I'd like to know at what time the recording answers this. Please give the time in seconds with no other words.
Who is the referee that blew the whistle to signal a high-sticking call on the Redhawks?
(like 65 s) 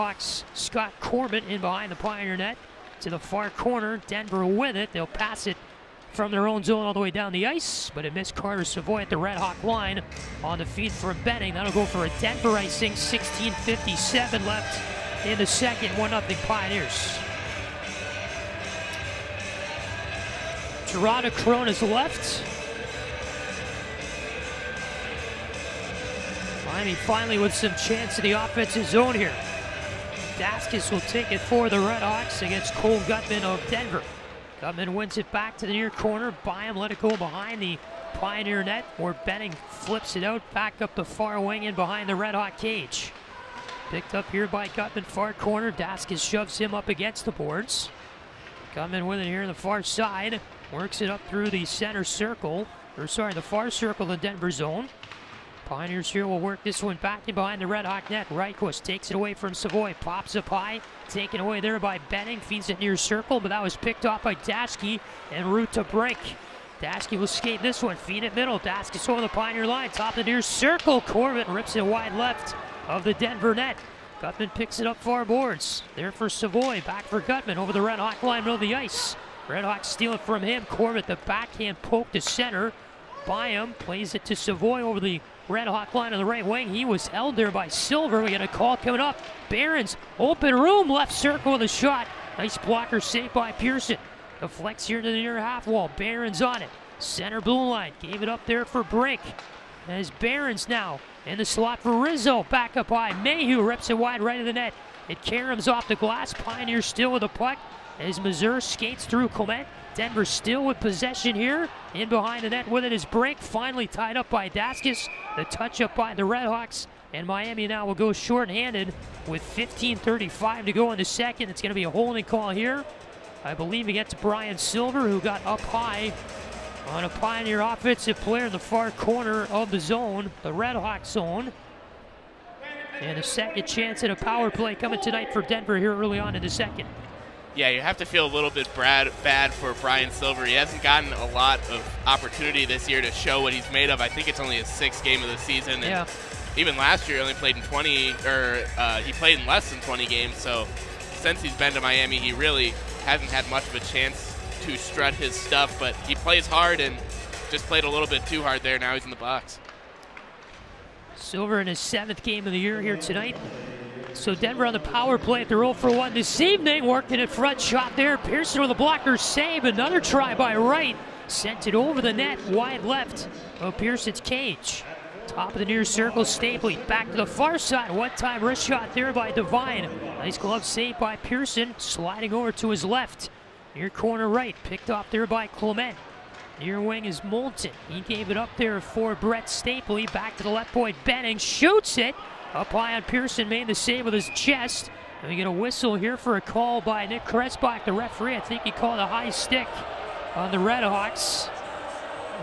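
197 s.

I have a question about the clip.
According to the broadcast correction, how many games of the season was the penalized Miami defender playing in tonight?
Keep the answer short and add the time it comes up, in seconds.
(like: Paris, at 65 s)
7, at 161 s.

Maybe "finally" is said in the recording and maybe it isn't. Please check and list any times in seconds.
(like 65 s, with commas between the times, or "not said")
26 s, 113 s.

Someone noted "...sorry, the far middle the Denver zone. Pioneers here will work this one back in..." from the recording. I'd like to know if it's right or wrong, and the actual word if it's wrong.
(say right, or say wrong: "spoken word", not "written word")
wrong: "circle", not "middle".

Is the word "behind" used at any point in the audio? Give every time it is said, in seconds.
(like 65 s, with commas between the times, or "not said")
1 s, 37 s, 41 s, 57 s, 112 s.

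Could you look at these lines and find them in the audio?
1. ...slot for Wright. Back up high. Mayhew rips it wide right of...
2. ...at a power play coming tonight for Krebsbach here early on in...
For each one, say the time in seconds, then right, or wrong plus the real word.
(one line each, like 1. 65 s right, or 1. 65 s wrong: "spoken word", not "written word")
1. 101 s wrong: "Rizzo", not "Wright"
2. 134 s wrong: "Denver", not "Krebsbach".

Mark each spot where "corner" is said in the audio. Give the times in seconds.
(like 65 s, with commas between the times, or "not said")
3 s, 35 s, 45 s, 128 s, 183 s.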